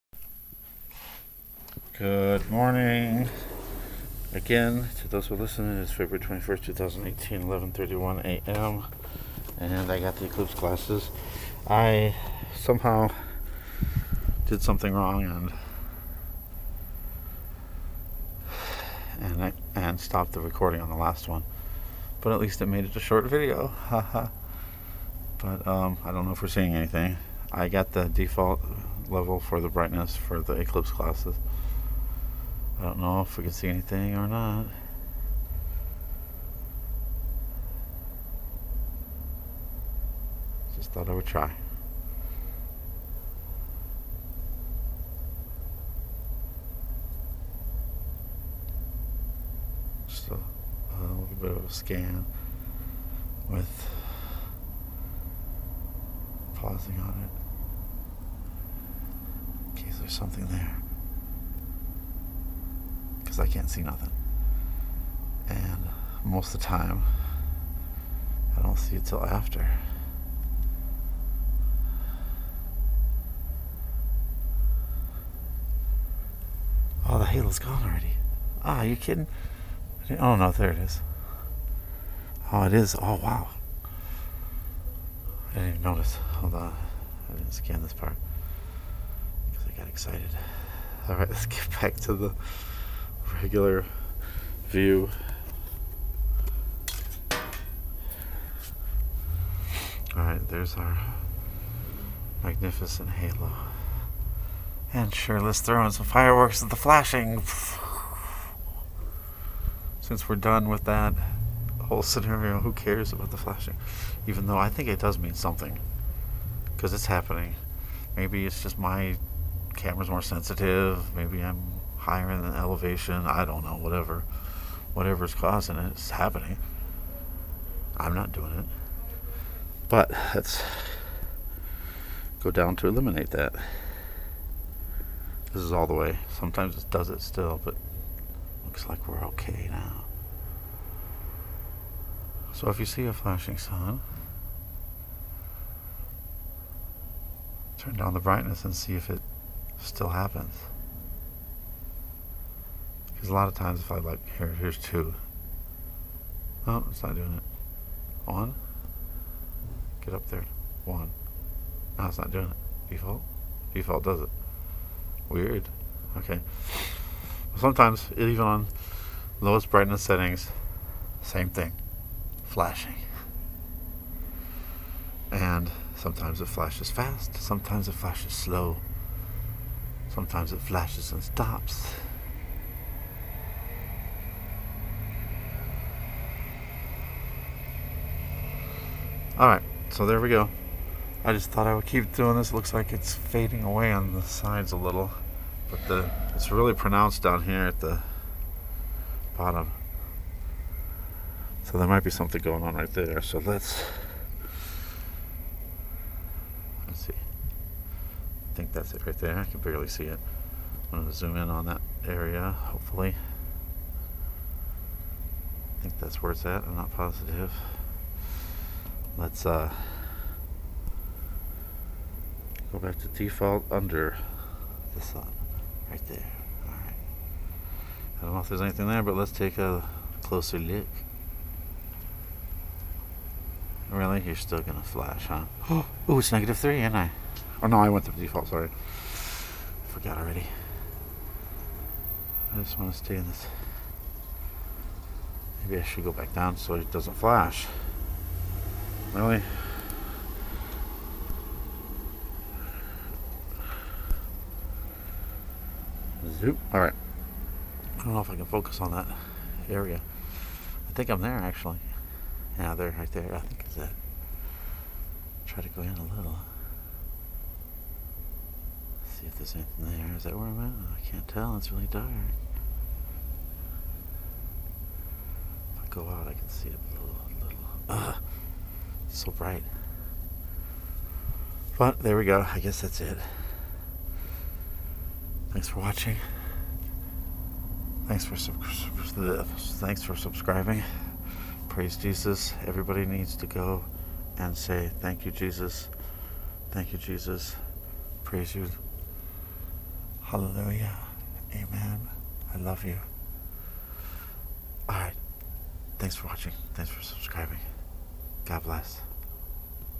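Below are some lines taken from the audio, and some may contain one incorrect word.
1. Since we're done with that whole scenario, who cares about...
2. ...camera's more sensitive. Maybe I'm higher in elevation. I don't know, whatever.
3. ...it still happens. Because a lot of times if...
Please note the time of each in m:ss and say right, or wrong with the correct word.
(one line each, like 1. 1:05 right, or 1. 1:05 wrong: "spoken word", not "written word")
1. 1:50 right
2. 1:59 right
3. 2:29 right.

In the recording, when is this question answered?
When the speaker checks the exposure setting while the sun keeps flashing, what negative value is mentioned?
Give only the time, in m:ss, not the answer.
3:56.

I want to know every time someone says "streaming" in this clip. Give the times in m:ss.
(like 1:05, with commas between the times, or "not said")
not said.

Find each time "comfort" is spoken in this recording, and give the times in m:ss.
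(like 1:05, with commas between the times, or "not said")
not said.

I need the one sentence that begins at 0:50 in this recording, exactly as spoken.
Just a, a little bit of a scan with pausing on it in case there's something there because I can't see nothing.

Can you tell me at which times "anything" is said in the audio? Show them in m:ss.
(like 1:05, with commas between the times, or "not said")
0:26, 0:33, 3:48, 4:29.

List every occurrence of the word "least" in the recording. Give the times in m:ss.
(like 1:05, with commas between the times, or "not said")
0:22.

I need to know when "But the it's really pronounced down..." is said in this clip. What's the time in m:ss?
3:15.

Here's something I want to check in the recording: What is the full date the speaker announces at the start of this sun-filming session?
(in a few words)
February 21st, 2018.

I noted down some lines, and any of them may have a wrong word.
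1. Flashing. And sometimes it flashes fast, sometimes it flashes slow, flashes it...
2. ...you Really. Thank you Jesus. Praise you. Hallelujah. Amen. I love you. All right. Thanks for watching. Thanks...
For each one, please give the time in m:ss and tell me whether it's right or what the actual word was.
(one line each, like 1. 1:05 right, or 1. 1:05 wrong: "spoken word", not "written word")
1. 2:52 wrong: "sometimes", not "flashes"
2. 4:55 wrong: "Jesus", not "Really".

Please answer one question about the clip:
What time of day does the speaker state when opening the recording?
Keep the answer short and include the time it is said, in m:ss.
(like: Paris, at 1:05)
11:31 a.m., at 0:07.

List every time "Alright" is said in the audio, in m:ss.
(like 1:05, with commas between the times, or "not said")
1:40, 3:09, 4:16.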